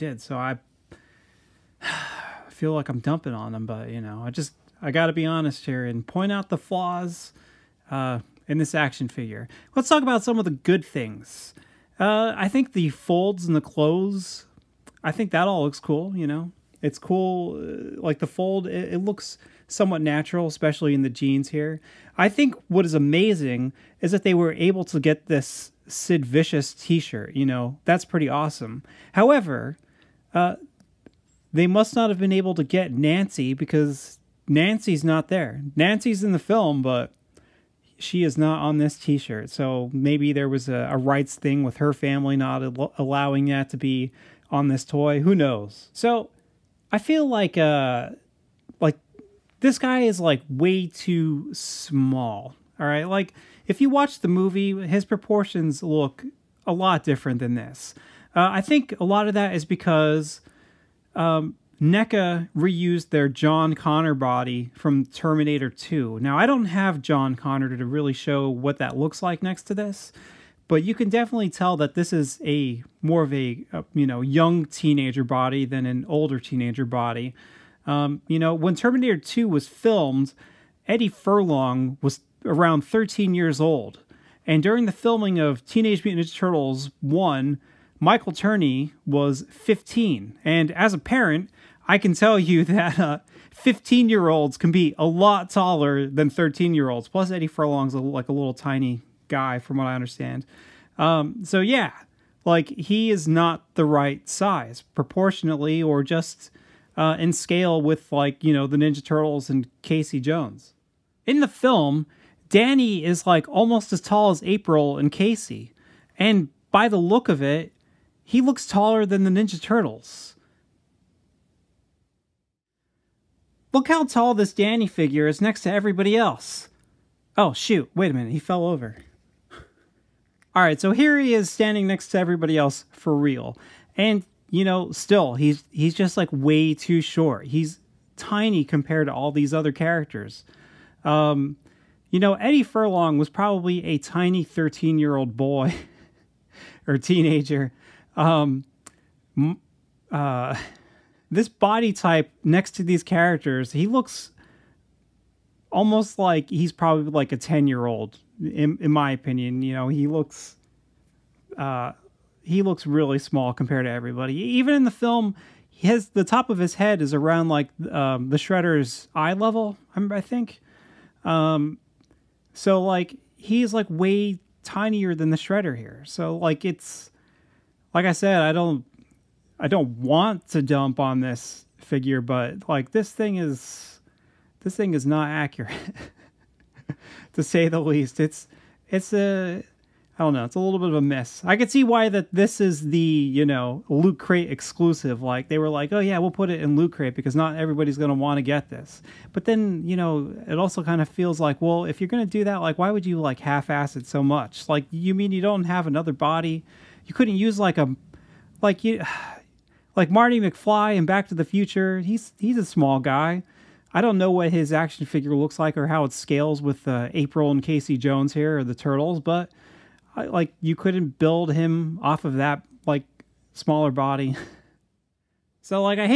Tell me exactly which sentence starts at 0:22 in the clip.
I think what is amazing is that they were able to get this Sid Vicious t shirt.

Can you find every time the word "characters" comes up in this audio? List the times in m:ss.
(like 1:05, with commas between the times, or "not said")
2:19, 2:33.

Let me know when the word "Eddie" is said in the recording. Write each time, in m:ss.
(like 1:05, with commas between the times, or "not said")
1:20, 1:37, 2:22.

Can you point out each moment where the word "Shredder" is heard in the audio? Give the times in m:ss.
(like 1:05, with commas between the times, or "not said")
2:48, 2:55.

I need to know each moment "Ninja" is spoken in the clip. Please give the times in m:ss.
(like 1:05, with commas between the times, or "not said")
1:26, 1:48, 1:59.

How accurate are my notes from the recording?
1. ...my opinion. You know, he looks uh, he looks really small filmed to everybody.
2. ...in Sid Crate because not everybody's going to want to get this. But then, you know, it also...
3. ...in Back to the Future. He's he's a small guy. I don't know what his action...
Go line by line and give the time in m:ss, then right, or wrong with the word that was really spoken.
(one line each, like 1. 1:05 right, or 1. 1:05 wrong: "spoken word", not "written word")
1. 2:38 wrong: "compared", not "filmed"
2. 3:16 wrong: "Loot", not "Sid"
3. 3:30 right.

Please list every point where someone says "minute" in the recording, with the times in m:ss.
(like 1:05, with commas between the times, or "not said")
2:08.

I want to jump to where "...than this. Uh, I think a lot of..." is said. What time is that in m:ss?
0:57.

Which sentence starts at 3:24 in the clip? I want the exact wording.
Like you mean you don't have another body?